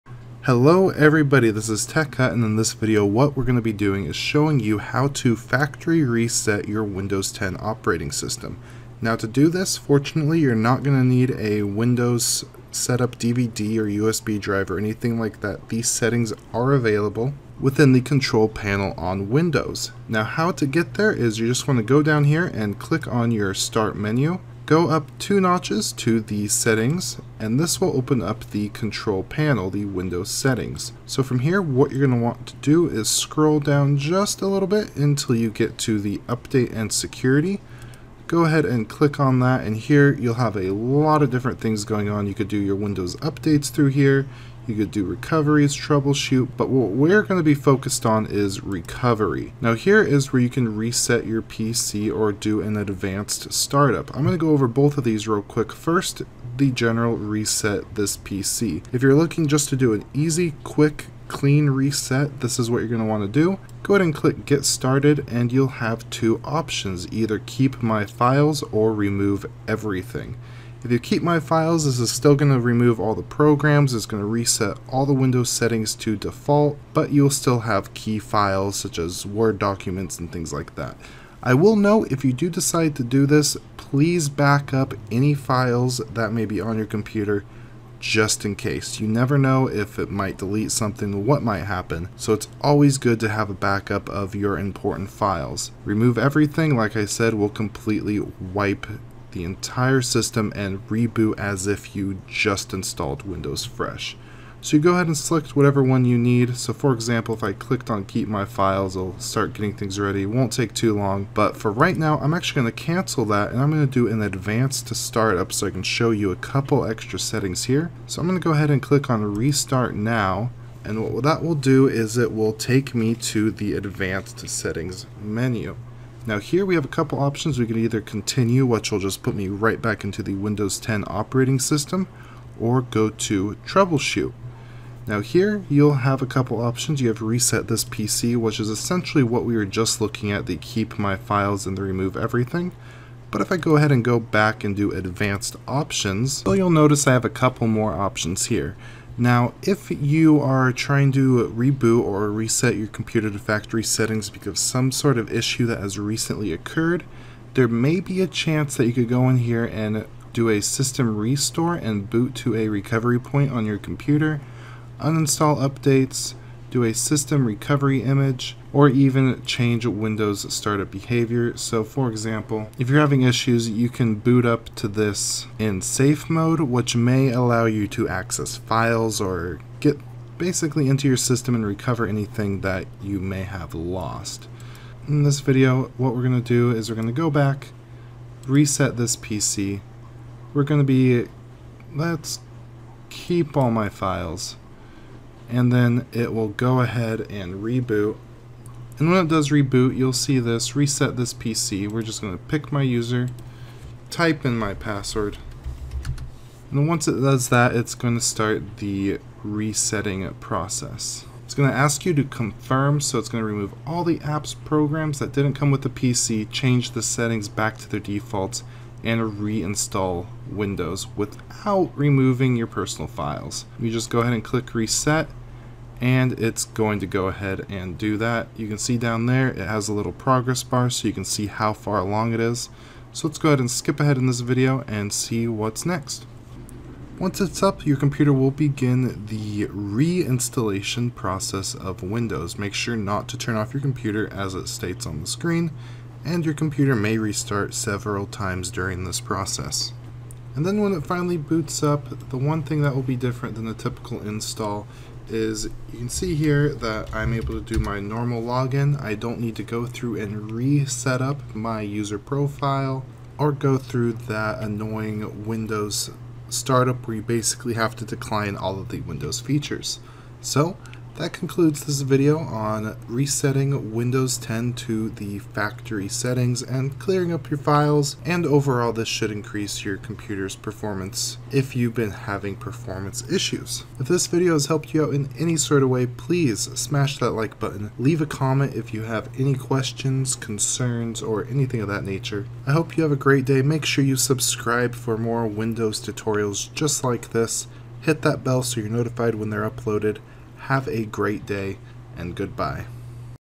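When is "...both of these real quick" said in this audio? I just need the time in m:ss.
0:54.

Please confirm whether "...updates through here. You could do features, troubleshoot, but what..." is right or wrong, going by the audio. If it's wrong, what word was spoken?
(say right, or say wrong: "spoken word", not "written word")
wrong: "recoveries", not "features".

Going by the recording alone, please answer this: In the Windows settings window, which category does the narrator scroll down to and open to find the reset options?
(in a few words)
Update and security.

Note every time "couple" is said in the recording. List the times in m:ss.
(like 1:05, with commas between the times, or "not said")
1:56, 2:06, 2:16, 2:27.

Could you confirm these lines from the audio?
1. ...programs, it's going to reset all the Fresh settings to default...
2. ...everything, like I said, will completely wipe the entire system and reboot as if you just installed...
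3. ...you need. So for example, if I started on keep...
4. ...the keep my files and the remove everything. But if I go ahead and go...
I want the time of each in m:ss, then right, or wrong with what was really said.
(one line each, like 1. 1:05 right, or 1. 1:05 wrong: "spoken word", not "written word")
1. 1:13 wrong: "Windows", not "Fresh"
2. 1:36 right
3. 1:46 wrong: "clicked", not "started"
4. 2:20 right.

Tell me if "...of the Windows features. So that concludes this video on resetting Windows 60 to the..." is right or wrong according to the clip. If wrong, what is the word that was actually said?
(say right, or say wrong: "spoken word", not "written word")
wrong: "10", not "60".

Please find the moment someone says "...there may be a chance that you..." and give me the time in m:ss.
2:37.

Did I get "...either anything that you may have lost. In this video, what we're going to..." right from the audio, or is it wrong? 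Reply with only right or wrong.
wrong.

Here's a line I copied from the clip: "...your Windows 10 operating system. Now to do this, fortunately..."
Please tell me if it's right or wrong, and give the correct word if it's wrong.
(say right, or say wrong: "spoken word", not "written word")
right.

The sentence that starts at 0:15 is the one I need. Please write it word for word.
These settings are available within the control panel on Windows.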